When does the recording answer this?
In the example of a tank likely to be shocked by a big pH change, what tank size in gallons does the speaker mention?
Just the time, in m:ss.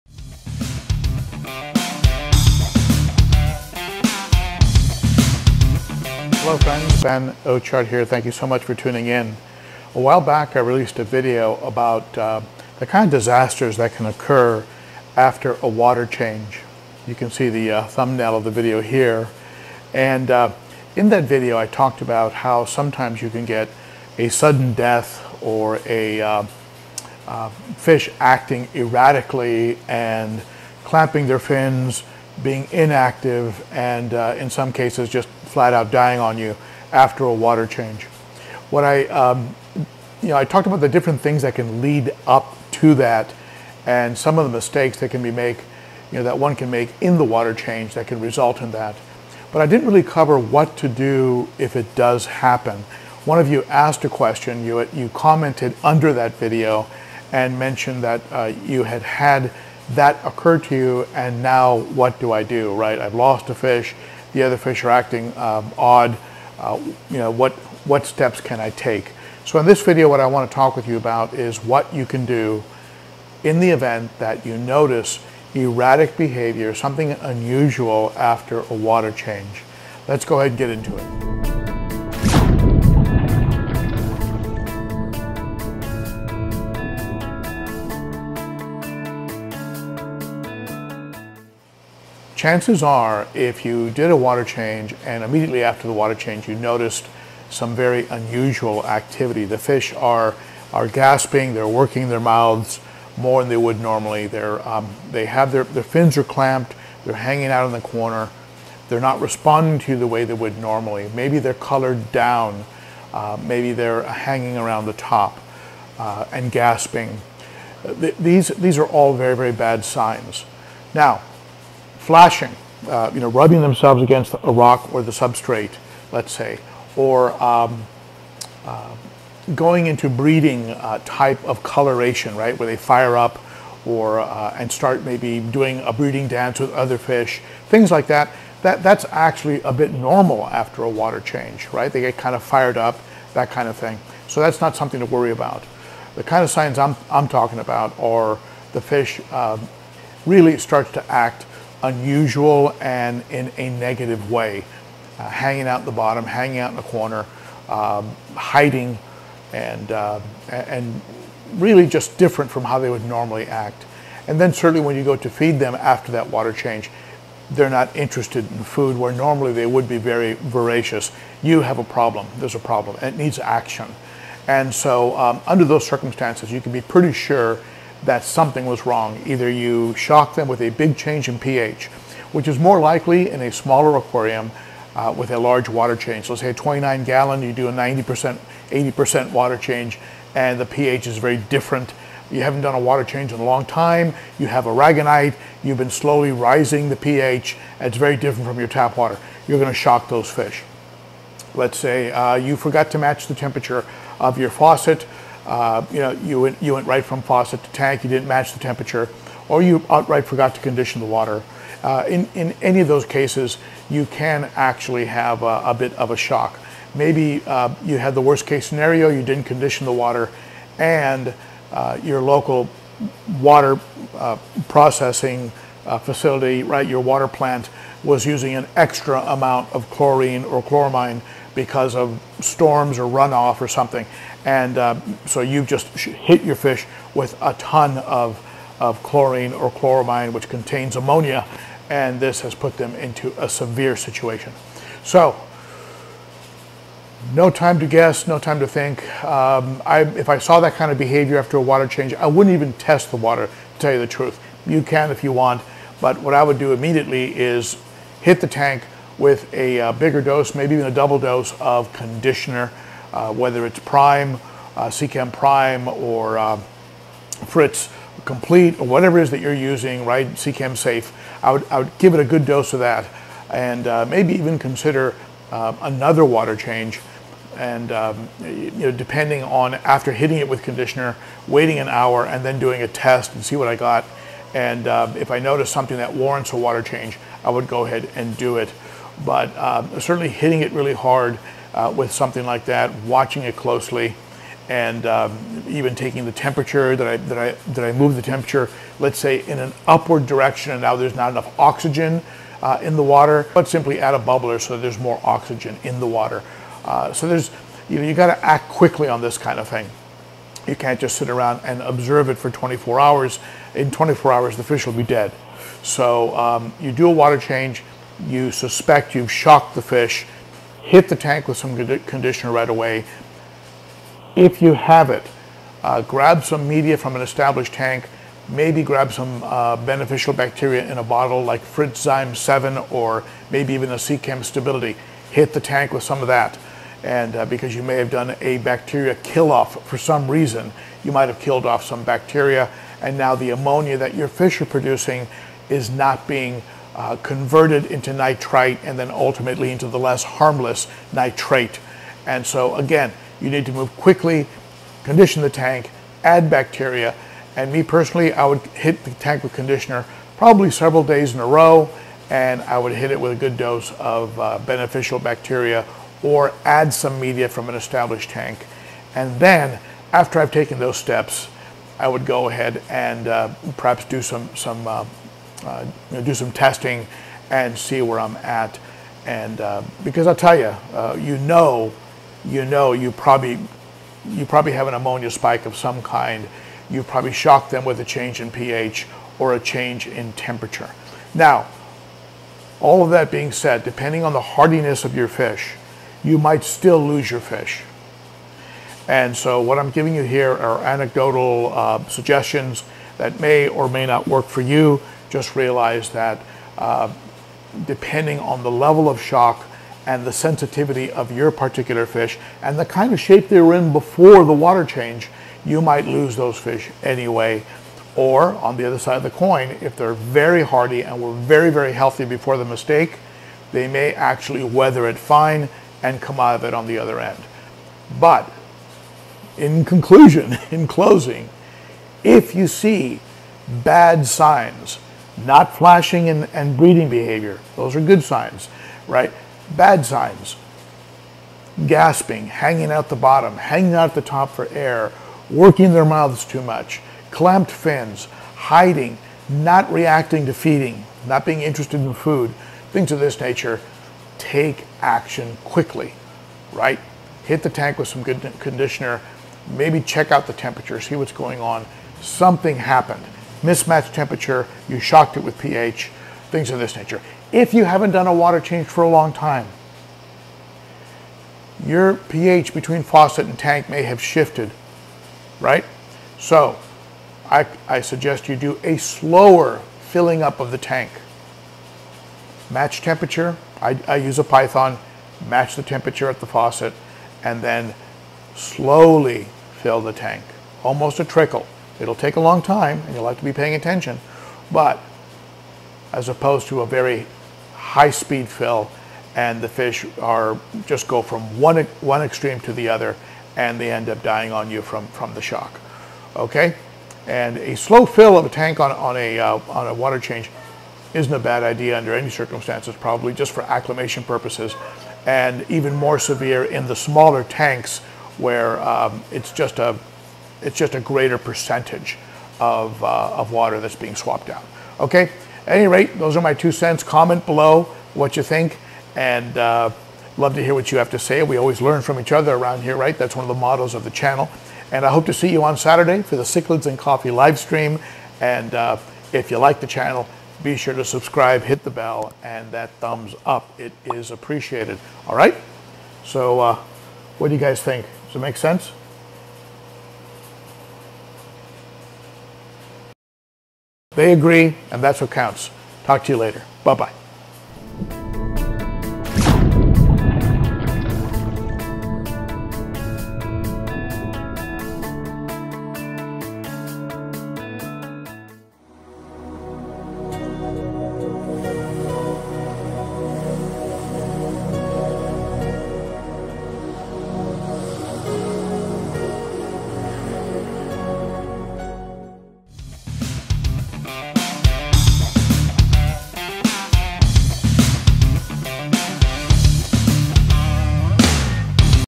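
3:06.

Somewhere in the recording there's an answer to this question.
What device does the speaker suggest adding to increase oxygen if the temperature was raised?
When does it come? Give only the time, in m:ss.
5:04.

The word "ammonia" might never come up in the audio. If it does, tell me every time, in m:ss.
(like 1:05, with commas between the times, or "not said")
4:00, 5:43, 6:24.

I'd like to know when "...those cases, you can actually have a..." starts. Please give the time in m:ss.
3:32.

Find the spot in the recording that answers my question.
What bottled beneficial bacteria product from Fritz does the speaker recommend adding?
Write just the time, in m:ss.
5:31.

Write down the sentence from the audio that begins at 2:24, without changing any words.
So that's not something to worry about.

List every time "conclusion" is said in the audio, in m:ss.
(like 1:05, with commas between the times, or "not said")
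7:09.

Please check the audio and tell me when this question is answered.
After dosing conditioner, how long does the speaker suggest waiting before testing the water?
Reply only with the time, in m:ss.
4:41.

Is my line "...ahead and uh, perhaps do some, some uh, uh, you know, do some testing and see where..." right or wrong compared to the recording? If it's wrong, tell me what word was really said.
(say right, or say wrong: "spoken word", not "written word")
right.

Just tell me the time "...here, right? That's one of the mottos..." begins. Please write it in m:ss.
8:52.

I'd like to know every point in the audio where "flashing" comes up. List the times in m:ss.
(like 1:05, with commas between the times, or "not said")
2:02, 7:15.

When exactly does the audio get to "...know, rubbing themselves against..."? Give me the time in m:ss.
2:03.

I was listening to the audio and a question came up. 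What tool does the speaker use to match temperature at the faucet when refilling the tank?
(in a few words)
a Python.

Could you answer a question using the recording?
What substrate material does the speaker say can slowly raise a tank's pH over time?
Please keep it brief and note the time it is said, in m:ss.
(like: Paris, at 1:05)
aragonite, at 3:14.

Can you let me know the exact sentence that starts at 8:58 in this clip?
And uh, if you like the channel, be sure to subscribe, hit the bell, and that thumbs up.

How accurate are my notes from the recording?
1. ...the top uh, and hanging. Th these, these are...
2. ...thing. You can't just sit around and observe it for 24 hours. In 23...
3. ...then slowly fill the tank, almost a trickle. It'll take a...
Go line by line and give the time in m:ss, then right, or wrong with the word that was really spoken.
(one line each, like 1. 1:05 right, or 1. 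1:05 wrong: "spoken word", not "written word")
1. 1:54 wrong: "gasping", not "hanging"
2. 5:09 wrong: "24", not "23"
3. 8:07 right.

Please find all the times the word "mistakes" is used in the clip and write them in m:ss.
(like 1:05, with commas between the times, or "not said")
0:44, 7:02.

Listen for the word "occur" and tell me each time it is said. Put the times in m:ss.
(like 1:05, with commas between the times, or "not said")
0:14, 1:00.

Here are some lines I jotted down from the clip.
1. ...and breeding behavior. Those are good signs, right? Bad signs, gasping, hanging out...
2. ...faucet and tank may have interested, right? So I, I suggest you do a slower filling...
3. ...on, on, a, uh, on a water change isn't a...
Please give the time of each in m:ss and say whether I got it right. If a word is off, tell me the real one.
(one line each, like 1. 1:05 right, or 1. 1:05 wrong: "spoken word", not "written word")
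1. 7:16 right
2. 7:53 wrong: "shifted", not "interested"
3. 8:28 right.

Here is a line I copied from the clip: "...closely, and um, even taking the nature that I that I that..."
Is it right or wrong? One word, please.
wrong.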